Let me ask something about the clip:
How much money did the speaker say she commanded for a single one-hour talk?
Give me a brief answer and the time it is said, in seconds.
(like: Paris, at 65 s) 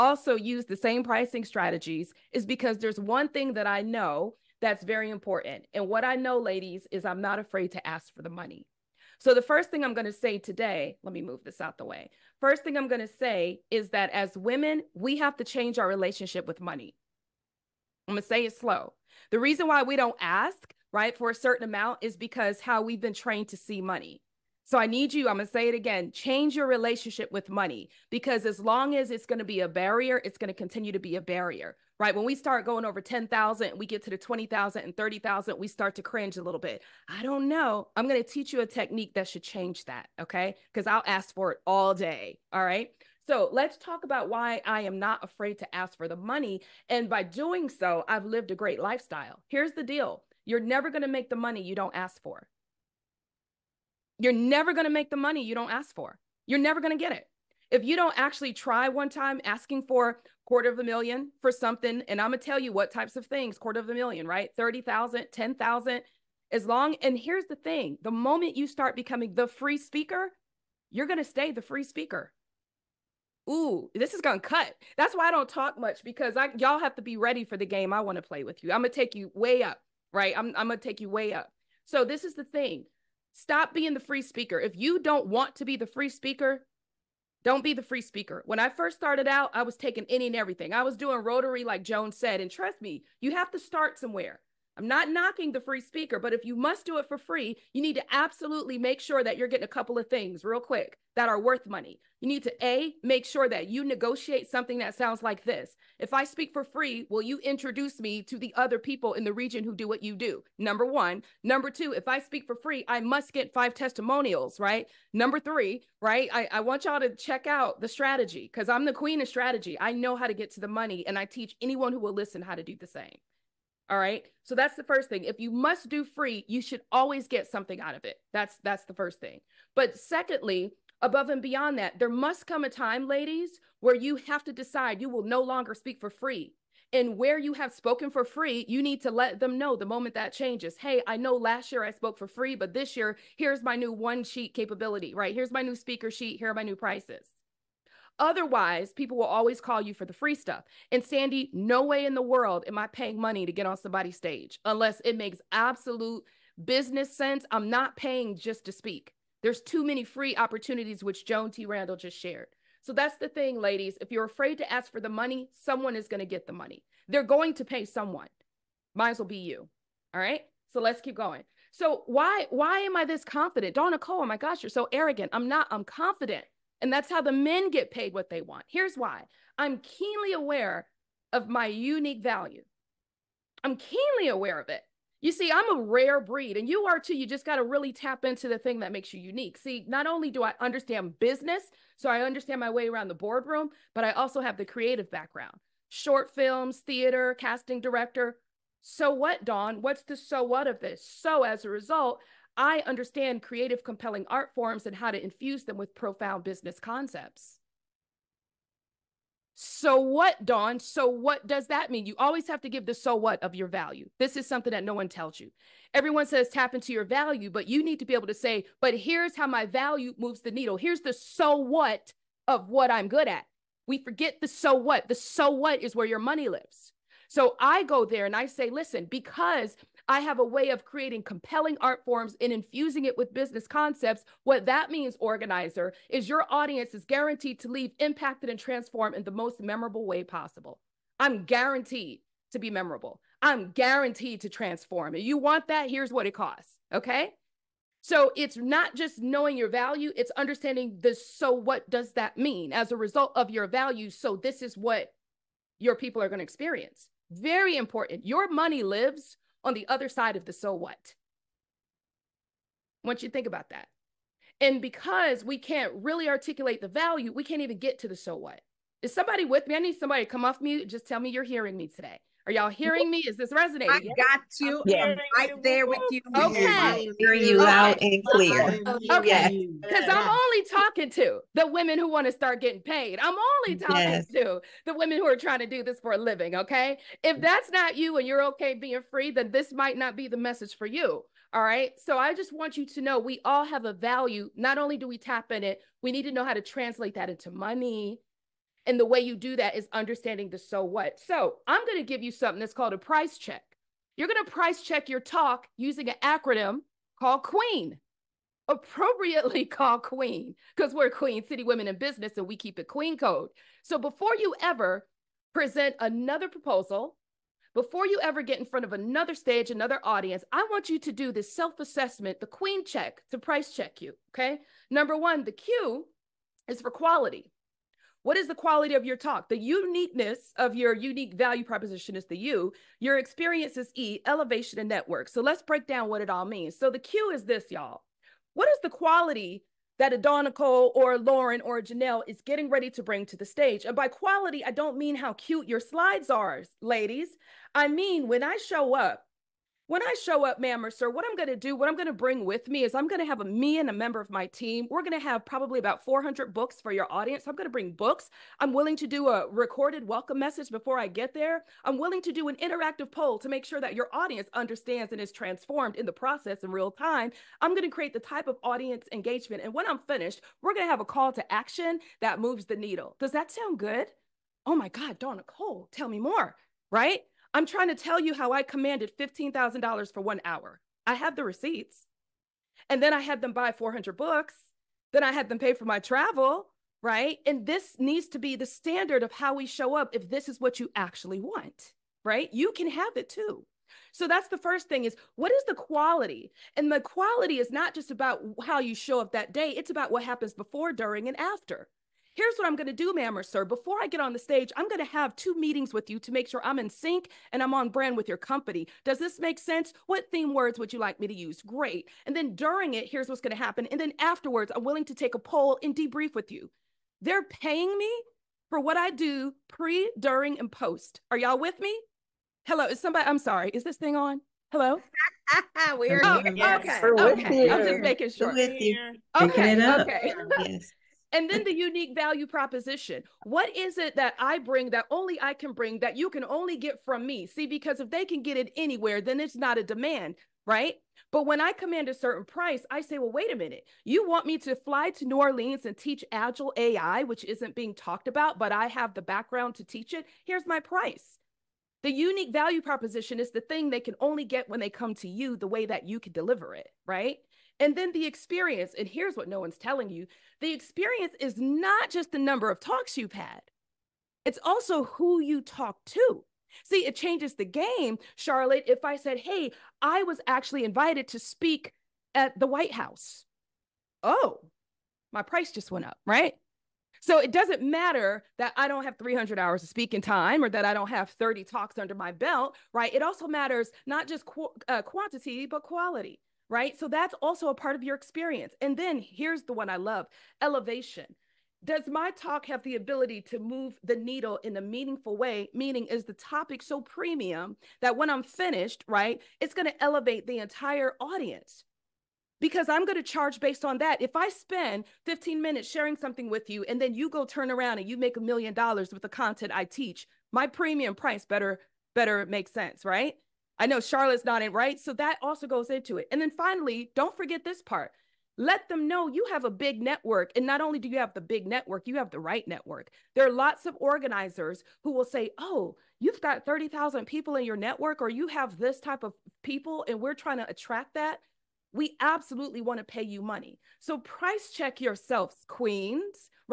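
$15,000, at 379 s.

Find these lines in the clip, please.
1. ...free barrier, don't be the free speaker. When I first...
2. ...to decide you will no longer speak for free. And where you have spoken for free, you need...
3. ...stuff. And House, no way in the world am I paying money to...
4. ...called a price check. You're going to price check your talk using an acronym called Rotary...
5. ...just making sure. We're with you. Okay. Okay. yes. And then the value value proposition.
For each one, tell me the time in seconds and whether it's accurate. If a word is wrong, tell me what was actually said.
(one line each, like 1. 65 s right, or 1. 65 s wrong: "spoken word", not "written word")
1. 85 s wrong: "speaker", not "barrier"
2. 134 s right
3. 150 s wrong: "Sandy", not "House"
4. 302 s wrong: "Queen", not "Rotary"
5. 427 s wrong: "unique", not "value".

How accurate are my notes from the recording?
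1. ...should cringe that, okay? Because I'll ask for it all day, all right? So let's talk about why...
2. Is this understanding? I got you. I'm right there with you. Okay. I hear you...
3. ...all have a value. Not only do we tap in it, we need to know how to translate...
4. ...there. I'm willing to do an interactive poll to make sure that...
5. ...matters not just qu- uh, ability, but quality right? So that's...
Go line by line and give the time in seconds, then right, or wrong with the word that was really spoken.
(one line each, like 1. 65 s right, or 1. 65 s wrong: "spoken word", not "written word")
1. 39 s wrong: "change", not "cringe"
2. 273 s wrong: "resonating", not "understanding"
3. 293 s right
4. 361 s right
5. 483 s wrong: "quantity", not "ability".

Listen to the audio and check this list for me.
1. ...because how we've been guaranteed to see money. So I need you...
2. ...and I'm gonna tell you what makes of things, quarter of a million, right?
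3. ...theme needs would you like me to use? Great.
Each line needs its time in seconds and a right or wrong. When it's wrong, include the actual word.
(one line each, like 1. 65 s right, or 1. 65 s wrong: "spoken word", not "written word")
1. 22 s wrong: "trained", not "guaranteed"
2. 62 s wrong: "types", not "makes"
3. 410 s wrong: "words", not "needs".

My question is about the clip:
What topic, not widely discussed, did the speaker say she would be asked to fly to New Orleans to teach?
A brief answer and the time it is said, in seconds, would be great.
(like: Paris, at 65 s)
Agile AI, at 446 s.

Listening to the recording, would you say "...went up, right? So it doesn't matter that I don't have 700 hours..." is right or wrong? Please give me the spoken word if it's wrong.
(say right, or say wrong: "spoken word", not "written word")
wrong: "300", not "700".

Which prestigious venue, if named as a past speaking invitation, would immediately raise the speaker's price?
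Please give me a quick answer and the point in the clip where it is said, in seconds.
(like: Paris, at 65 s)
The White House, at 472 s.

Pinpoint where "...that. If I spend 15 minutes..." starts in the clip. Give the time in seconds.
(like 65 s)
503 s.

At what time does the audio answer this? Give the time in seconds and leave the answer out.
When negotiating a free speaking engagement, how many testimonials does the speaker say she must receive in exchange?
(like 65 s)
113 s.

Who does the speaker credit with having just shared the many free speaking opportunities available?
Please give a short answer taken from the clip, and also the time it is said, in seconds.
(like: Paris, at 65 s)
Joan T. Randall, at 161 s.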